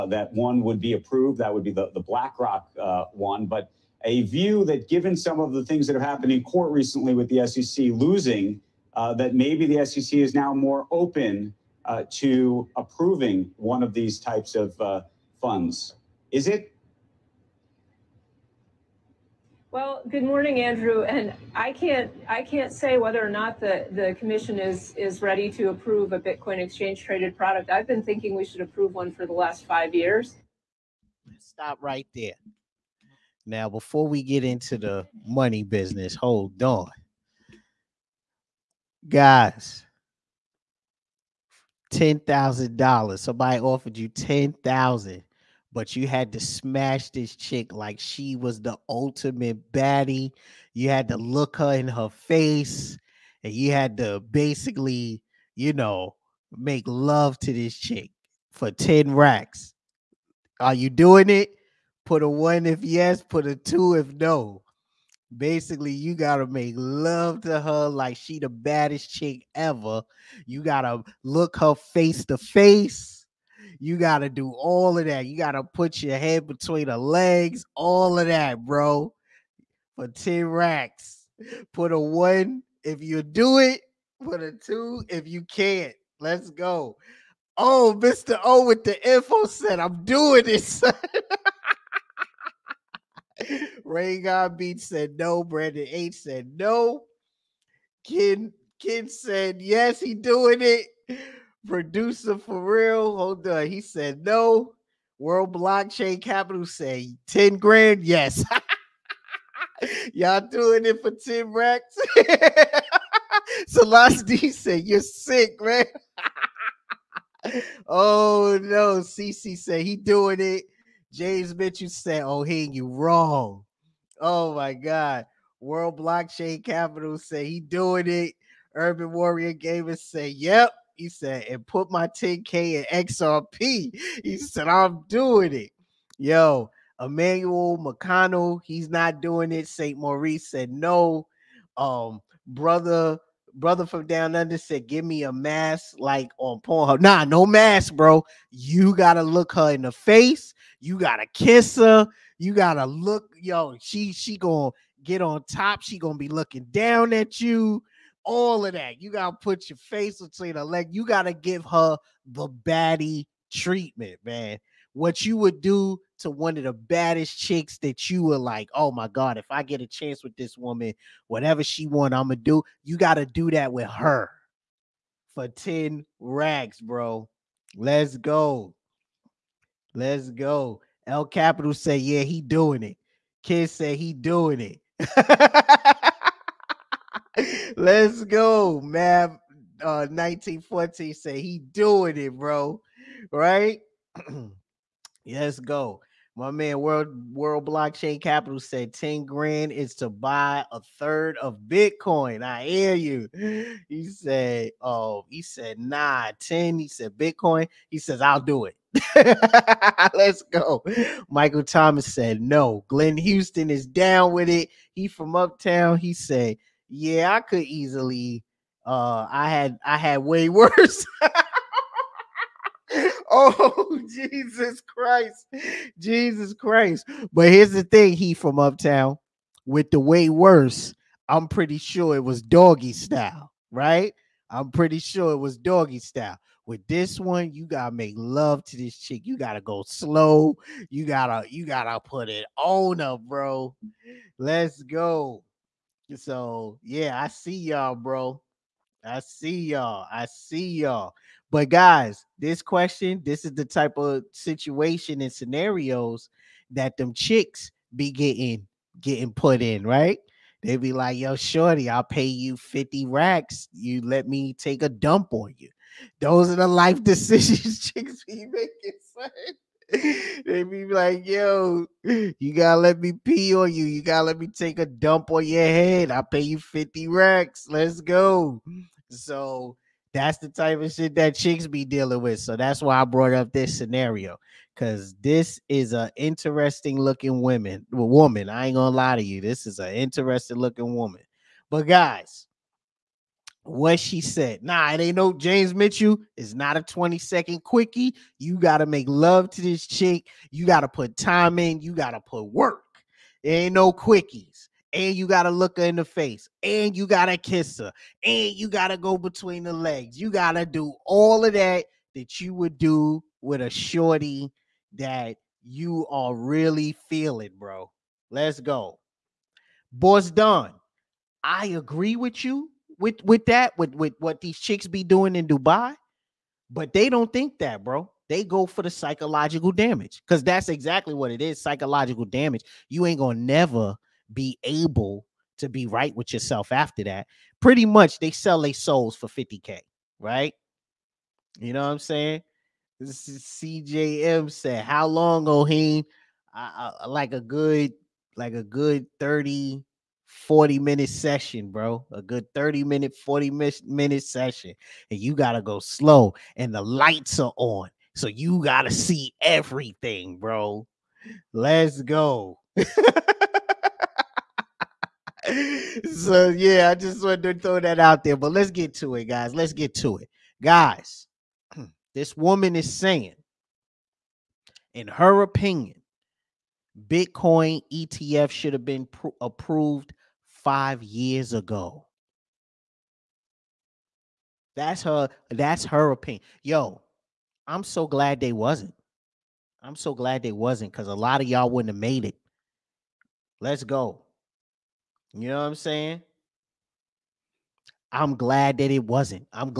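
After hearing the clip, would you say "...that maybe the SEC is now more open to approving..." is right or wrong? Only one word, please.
right.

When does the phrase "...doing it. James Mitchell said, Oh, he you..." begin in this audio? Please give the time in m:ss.
1:59.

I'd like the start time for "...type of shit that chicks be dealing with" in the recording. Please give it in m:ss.
4:40.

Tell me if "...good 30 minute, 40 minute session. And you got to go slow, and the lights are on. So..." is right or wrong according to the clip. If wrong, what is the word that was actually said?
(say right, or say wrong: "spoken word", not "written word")
right.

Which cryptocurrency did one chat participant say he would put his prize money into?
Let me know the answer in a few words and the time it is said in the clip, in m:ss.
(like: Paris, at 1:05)
XRP, at 2:13.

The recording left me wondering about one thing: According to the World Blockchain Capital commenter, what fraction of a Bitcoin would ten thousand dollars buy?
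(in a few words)
a third.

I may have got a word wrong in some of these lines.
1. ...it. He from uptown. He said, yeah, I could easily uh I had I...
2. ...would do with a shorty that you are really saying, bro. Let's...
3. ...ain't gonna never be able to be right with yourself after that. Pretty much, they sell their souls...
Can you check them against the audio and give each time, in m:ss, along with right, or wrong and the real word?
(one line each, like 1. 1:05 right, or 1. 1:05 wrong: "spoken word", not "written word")
1. 3:34 right
2. 5:12 wrong: "feeling", not "saying"
3. 5:33 right.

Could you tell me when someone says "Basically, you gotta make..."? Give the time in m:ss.
1:05.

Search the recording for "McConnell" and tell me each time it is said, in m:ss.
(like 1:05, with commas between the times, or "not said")
2:17.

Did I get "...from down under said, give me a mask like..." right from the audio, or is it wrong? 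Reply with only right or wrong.
right.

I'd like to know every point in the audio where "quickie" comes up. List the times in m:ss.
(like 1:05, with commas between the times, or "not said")
4:57, 5:03.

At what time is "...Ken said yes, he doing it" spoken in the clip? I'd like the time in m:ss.
1:38.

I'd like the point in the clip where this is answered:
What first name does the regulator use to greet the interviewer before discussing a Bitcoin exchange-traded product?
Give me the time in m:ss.
0:20.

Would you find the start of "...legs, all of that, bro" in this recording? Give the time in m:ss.
1:16.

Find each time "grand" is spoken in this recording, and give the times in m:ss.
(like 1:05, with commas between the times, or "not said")
1:47, 3:19.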